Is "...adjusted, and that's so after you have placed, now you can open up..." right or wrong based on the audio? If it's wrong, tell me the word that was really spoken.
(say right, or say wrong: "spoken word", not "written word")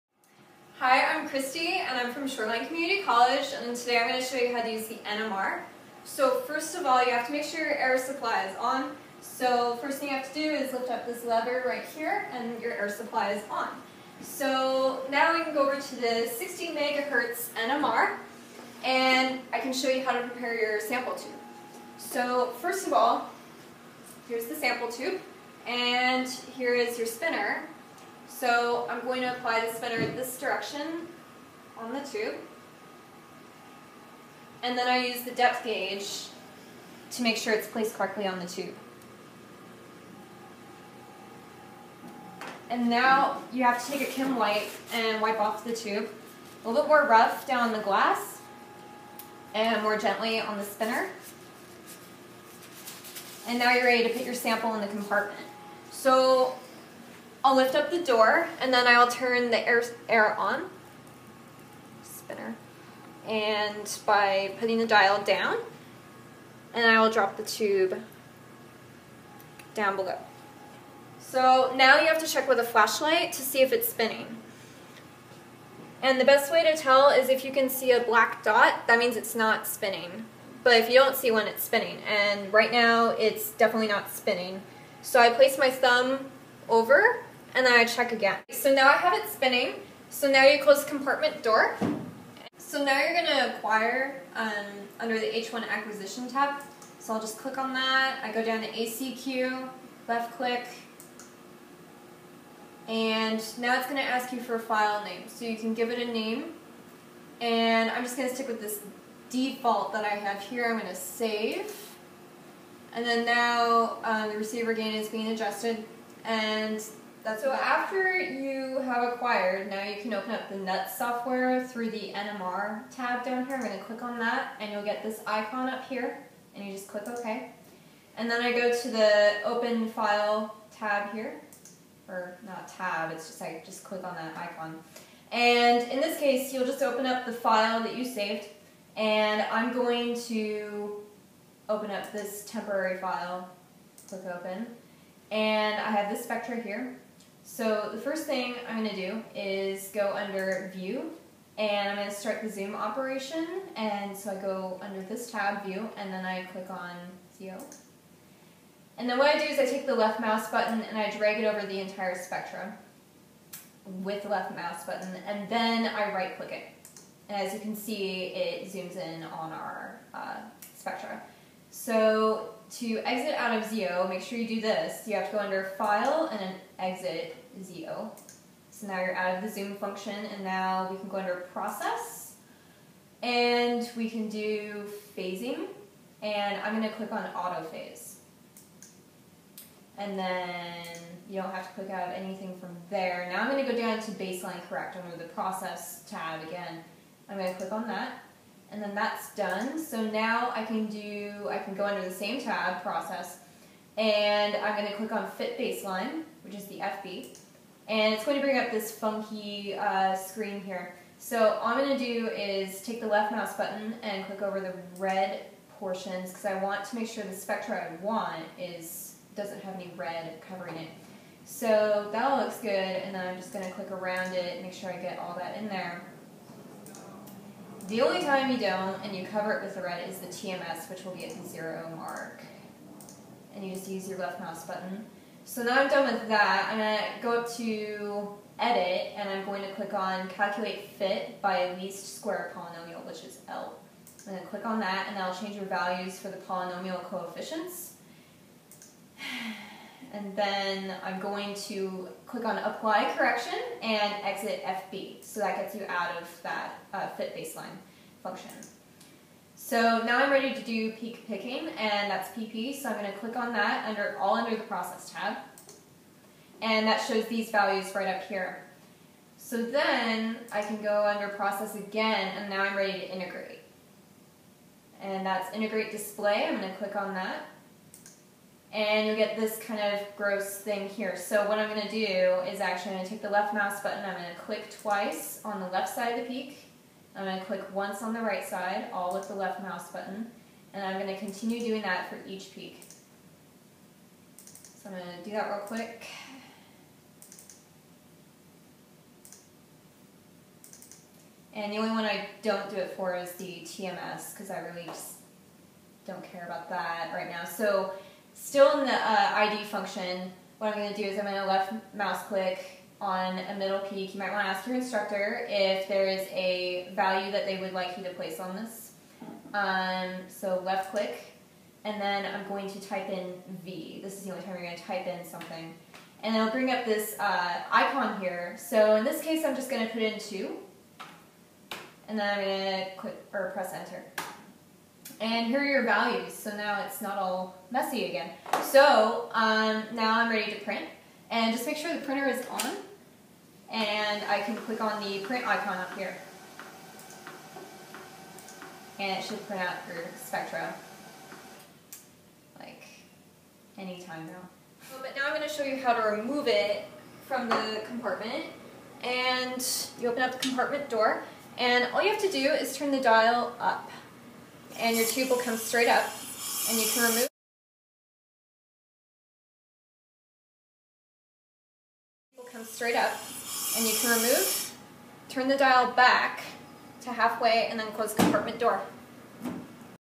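wrong: "acquired", not "placed".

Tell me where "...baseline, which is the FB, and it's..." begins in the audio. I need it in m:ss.
3:25.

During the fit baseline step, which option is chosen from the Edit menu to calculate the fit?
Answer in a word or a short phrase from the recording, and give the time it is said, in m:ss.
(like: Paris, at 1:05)
least square polynomial, at 4:01.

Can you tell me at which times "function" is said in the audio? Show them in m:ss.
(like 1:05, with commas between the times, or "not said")
2:59, 4:18, 5:09.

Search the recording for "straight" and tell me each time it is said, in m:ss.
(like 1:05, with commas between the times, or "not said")
6:05, 6:12.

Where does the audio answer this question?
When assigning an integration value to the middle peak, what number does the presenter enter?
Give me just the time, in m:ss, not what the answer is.
5:30.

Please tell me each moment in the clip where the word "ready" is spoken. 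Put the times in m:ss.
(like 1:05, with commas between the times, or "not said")
0:53, 4:20, 4:32, 5:40.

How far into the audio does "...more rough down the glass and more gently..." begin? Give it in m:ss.
0:46.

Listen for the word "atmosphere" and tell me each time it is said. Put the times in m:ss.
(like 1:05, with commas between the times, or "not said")
not said.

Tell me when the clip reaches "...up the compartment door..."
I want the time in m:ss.
6:00.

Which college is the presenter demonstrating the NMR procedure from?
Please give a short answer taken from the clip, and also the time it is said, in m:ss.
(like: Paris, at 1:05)
Shoreline Community College, at 0:02.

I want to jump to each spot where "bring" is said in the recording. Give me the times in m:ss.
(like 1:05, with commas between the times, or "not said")
3:28, 5:26.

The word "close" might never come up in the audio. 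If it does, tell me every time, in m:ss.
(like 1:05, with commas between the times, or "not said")
1:30, 6:17.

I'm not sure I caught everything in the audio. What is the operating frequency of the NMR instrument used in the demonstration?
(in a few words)
60 megahertz.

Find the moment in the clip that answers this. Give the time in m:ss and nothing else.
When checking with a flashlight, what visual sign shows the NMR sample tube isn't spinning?
1:18.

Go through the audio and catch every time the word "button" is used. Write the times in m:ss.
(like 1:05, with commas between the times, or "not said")
2:40, 2:44, 3:33, 3:54, 4:43, 4:49.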